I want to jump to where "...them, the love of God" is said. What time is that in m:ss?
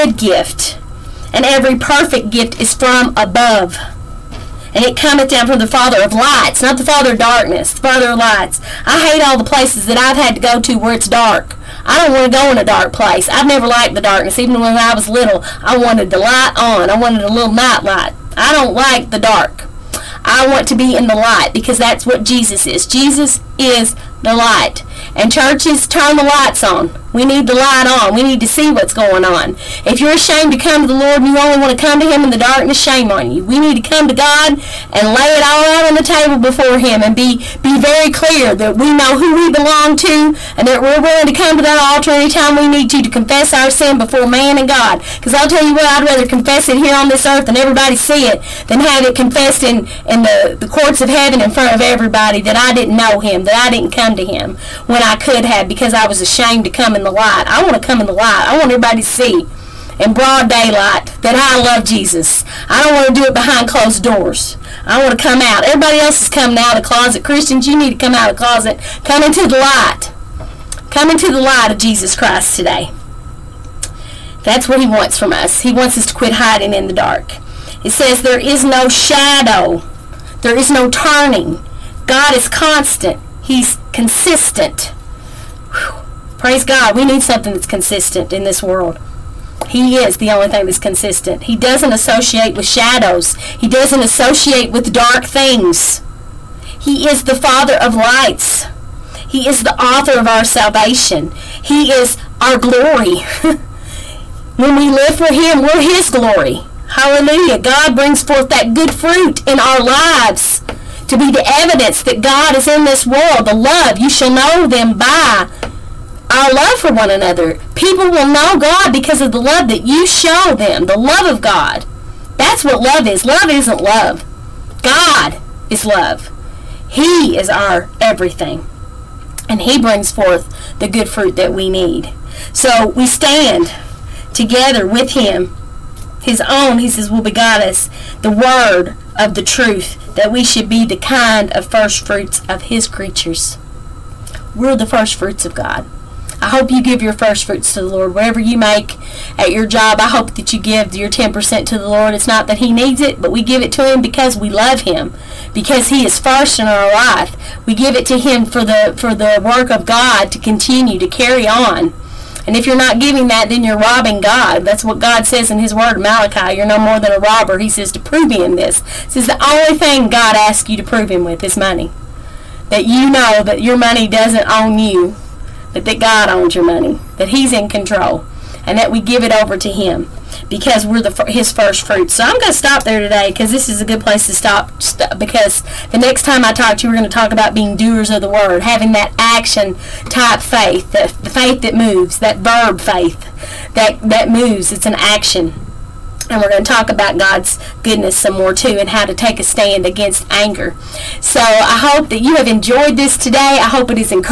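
2:00.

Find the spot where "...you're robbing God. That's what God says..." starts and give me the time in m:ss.
2:43.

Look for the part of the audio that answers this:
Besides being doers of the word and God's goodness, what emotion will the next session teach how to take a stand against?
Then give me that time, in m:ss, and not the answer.
3:20.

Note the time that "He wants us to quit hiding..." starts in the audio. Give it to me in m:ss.
1:15.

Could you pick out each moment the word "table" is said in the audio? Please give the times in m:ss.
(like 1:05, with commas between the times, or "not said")
0:36.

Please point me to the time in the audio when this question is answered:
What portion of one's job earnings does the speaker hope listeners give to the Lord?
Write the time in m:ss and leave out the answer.
2:31.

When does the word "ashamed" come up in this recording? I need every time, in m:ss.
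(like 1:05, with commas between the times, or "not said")
0:30, 0:56.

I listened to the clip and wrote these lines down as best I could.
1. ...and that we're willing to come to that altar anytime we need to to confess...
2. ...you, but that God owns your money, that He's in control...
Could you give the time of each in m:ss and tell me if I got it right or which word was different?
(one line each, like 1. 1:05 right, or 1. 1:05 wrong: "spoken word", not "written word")
1. 0:40 right
2. 2:54 right.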